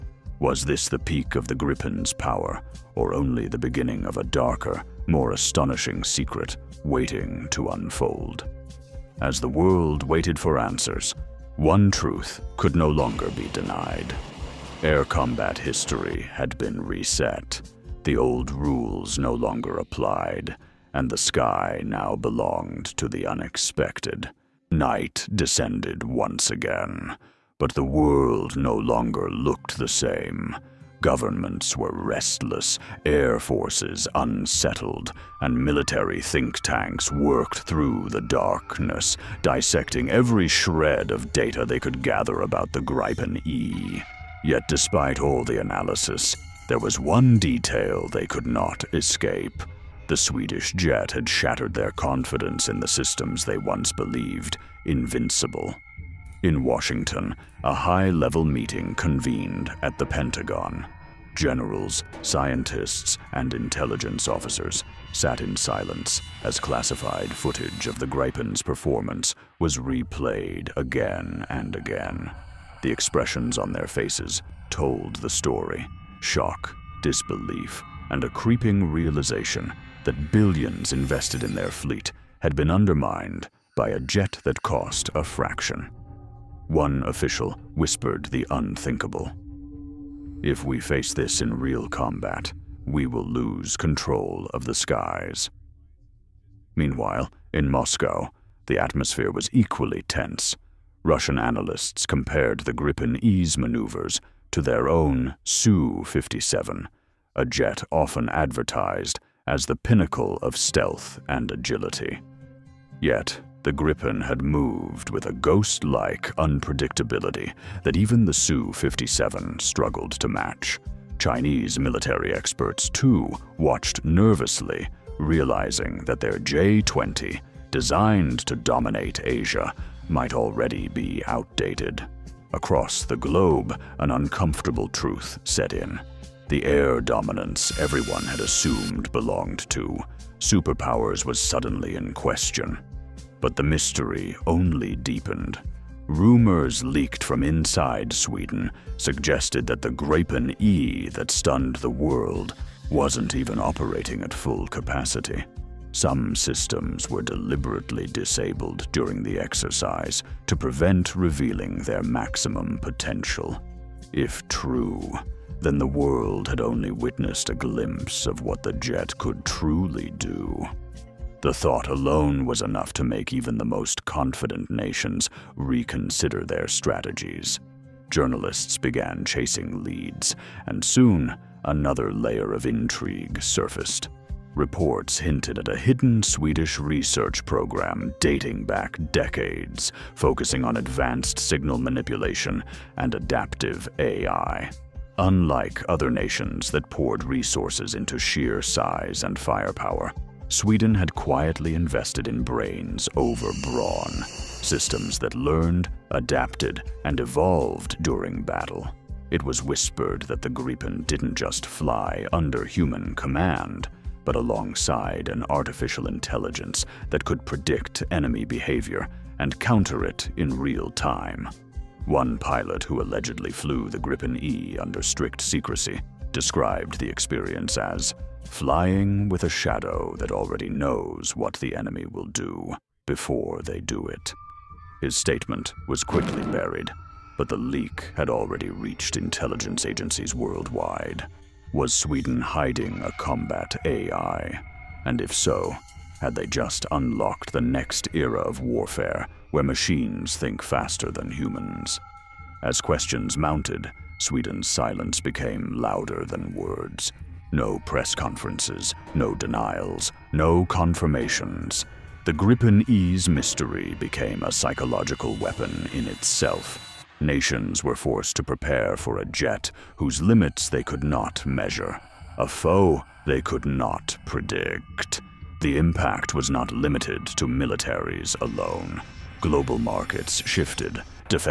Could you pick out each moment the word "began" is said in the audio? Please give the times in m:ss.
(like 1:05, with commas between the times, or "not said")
2:58.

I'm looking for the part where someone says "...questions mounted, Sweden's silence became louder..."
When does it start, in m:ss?
4:12.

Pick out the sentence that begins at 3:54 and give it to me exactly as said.
His statement was quickly buried, but the leak had already reached intelligence agencies worldwide.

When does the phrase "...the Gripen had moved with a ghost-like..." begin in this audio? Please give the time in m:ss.
1:53.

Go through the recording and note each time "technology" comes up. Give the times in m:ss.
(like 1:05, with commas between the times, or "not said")
not said.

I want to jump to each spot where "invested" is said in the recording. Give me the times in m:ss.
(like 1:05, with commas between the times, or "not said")
1:20, 3:21.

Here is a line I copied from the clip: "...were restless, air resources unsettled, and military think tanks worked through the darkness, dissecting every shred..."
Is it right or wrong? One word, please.
wrong.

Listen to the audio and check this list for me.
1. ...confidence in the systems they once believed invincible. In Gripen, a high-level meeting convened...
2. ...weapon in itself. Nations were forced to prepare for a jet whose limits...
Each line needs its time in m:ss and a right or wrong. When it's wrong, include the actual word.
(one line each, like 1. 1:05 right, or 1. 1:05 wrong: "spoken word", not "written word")
1. 0:51 wrong: "Washington", not "Gripen"
2. 4:25 right.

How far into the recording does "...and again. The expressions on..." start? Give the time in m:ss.
1:11.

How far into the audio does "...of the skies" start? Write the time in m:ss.
1:34.